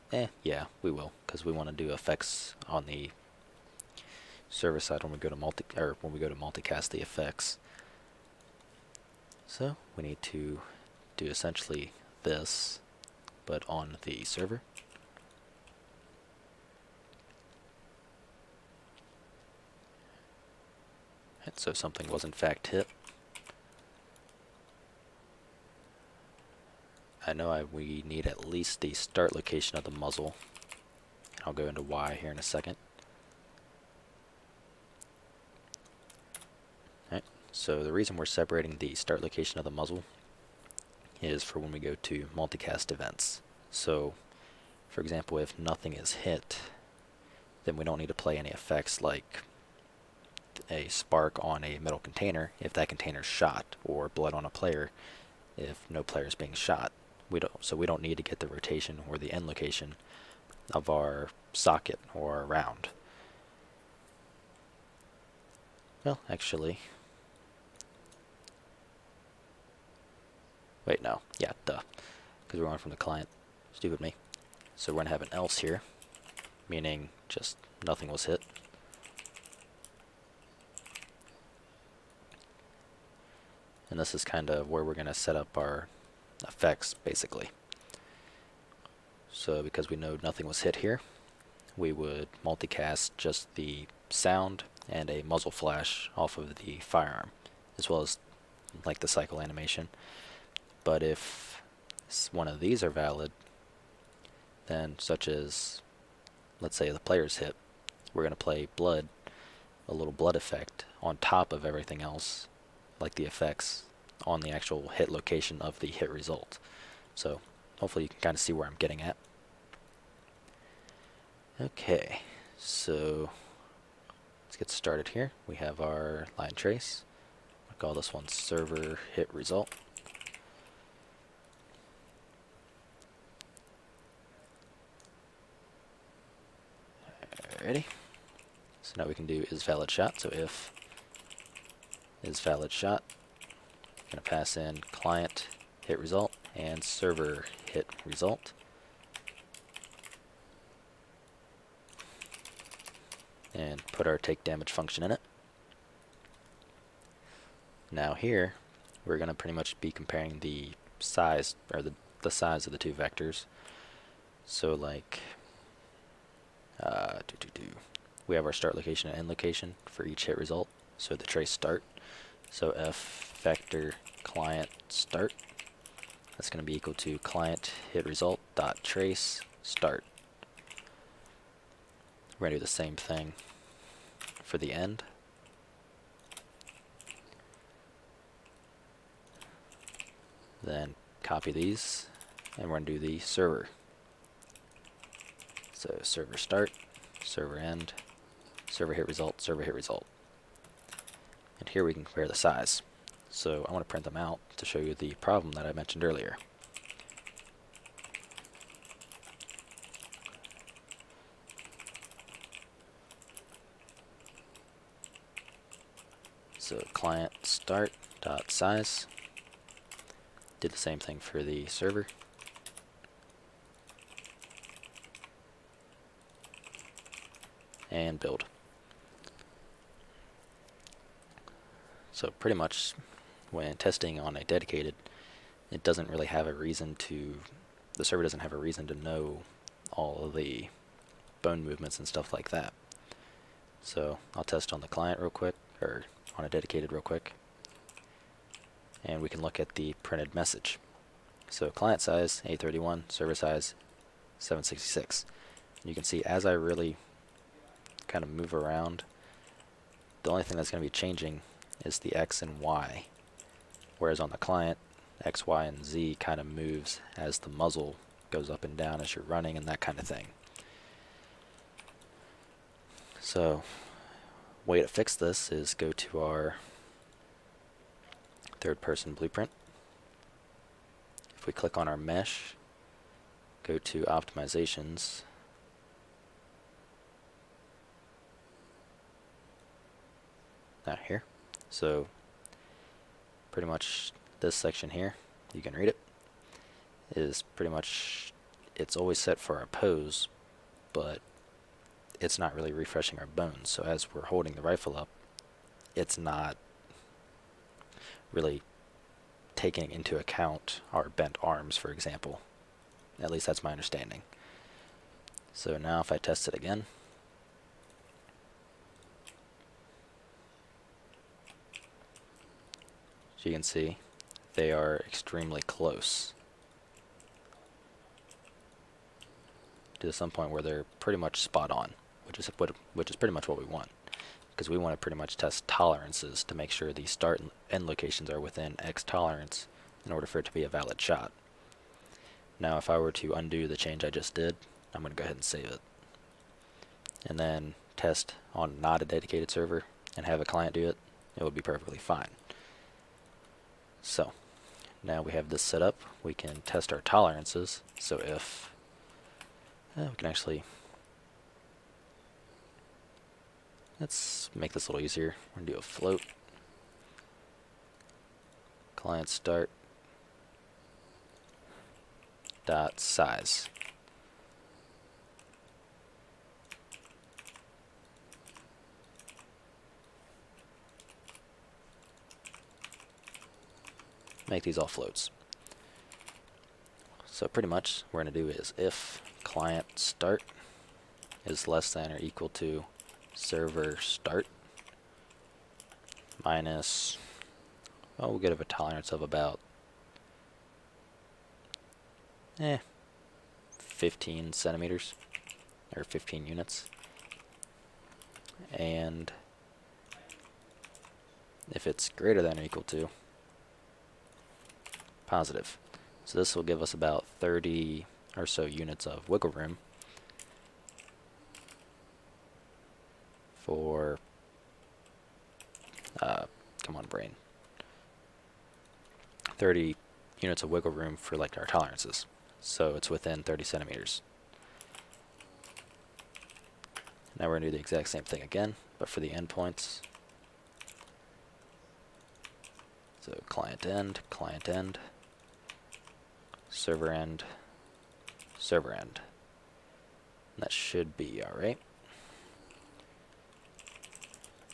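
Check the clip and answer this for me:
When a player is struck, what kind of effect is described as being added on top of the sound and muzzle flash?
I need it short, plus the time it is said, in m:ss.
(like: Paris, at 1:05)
blood effect, at 1:50.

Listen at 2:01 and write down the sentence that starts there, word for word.
Okay, so let's get started here.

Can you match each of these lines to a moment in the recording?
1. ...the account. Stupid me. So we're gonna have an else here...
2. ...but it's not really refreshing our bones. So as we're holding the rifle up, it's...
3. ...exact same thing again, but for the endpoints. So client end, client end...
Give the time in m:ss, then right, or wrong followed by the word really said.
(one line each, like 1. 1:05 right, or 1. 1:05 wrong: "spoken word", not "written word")
1. 1:12 wrong: "client", not "account"
2. 5:00 right
3. 7:17 right.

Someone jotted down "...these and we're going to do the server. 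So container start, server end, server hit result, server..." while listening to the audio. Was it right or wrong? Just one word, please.
wrong.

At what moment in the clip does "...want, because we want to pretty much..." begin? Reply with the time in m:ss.
5:33.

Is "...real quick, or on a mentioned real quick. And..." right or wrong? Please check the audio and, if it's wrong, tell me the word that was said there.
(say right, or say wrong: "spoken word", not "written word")
wrong: "dedicated", not "mentioned".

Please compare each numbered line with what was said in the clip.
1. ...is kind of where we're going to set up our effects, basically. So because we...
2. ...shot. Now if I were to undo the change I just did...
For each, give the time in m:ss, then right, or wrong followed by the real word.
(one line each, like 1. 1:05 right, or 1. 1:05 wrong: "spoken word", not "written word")
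1. 1:24 right
2. 5:40 right.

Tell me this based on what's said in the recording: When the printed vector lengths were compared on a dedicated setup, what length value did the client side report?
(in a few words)
831.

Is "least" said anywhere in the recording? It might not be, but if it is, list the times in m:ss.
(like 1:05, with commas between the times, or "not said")
0:28, 5:13.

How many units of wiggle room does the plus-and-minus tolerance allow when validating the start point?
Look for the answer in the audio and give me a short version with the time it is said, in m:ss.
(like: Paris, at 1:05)
30, at 7:09.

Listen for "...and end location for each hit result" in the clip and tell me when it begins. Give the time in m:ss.
2:49.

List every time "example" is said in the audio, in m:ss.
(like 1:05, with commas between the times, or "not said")
0:44, 5:11.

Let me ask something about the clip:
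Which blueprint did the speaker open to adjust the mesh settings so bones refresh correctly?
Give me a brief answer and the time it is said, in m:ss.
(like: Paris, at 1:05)
third person blueprint, at 4:38.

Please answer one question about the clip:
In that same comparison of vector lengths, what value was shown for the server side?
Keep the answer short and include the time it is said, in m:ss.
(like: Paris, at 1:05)
766, at 4:14.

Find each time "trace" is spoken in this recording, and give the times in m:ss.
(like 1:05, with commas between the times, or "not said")
2:06, 2:51, 2:58.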